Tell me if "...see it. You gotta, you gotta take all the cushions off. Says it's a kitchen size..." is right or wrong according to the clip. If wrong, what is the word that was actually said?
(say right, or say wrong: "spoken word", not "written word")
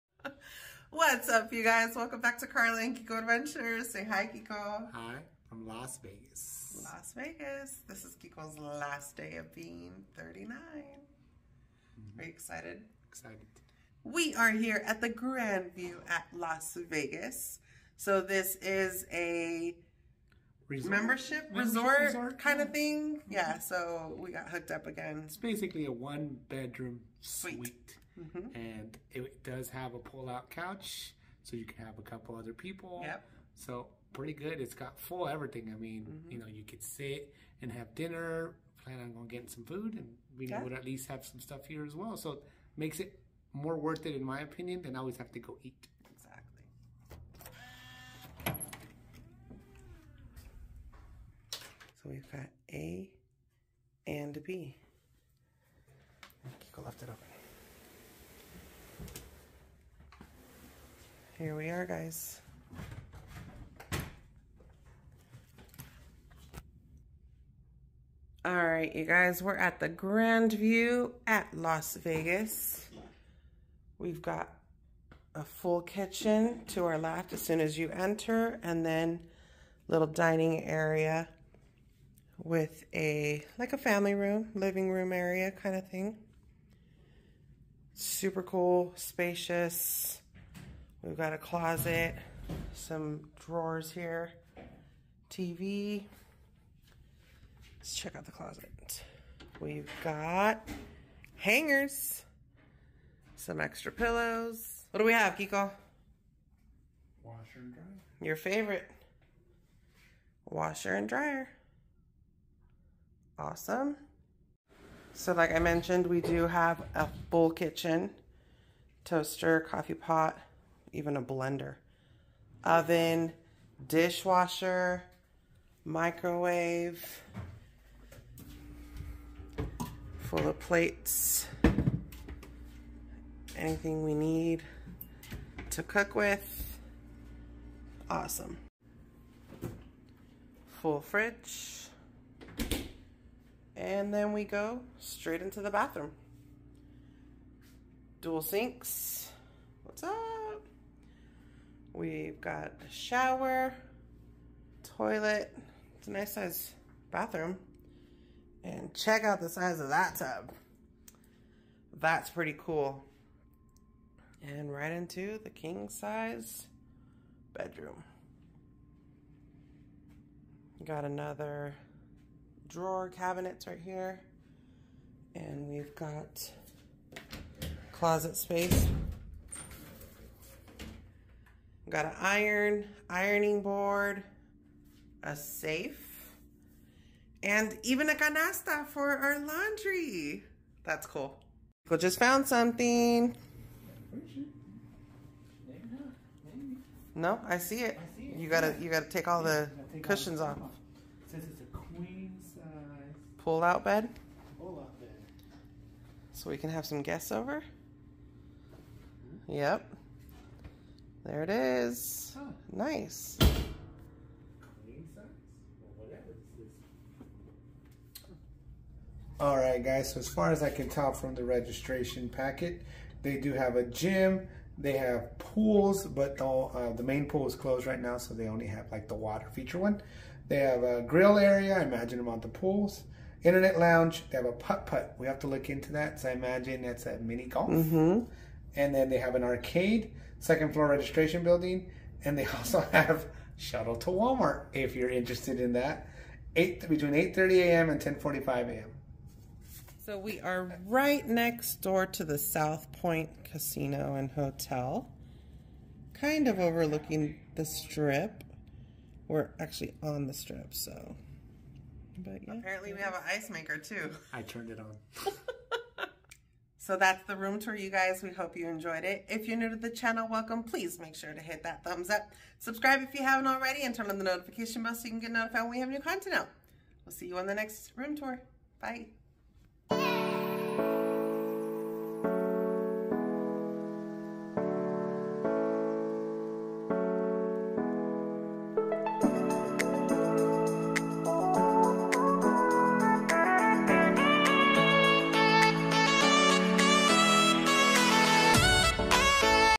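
wrong: "queen", not "kitchen".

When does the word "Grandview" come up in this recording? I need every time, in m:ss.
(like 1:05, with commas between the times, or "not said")
0:15, 1:09.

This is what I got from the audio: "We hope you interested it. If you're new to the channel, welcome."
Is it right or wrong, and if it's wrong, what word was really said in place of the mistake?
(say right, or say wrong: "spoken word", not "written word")
wrong: "enjoyed", not "interested".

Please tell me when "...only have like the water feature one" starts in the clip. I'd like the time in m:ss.
3:48.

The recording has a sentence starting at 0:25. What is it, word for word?
It's basically a one bedroom suite.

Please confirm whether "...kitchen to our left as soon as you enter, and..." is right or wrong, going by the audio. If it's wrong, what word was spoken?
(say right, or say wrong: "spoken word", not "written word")
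right.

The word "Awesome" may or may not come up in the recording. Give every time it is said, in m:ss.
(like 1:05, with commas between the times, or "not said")
1:53, 2:18.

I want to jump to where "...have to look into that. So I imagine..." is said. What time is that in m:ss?
3:55.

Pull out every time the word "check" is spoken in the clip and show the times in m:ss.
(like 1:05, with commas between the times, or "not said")
1:37, 2:38.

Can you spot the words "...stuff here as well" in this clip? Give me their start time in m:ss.
0:41.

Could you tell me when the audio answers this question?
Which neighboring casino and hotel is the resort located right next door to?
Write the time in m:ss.
4:12.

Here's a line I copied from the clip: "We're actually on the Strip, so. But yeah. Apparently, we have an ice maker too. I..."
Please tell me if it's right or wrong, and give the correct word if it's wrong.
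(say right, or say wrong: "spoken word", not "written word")
right.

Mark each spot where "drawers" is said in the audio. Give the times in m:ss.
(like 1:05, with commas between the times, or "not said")
1:33, 2:52.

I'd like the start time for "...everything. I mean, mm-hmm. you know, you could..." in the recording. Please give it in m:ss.
0:35.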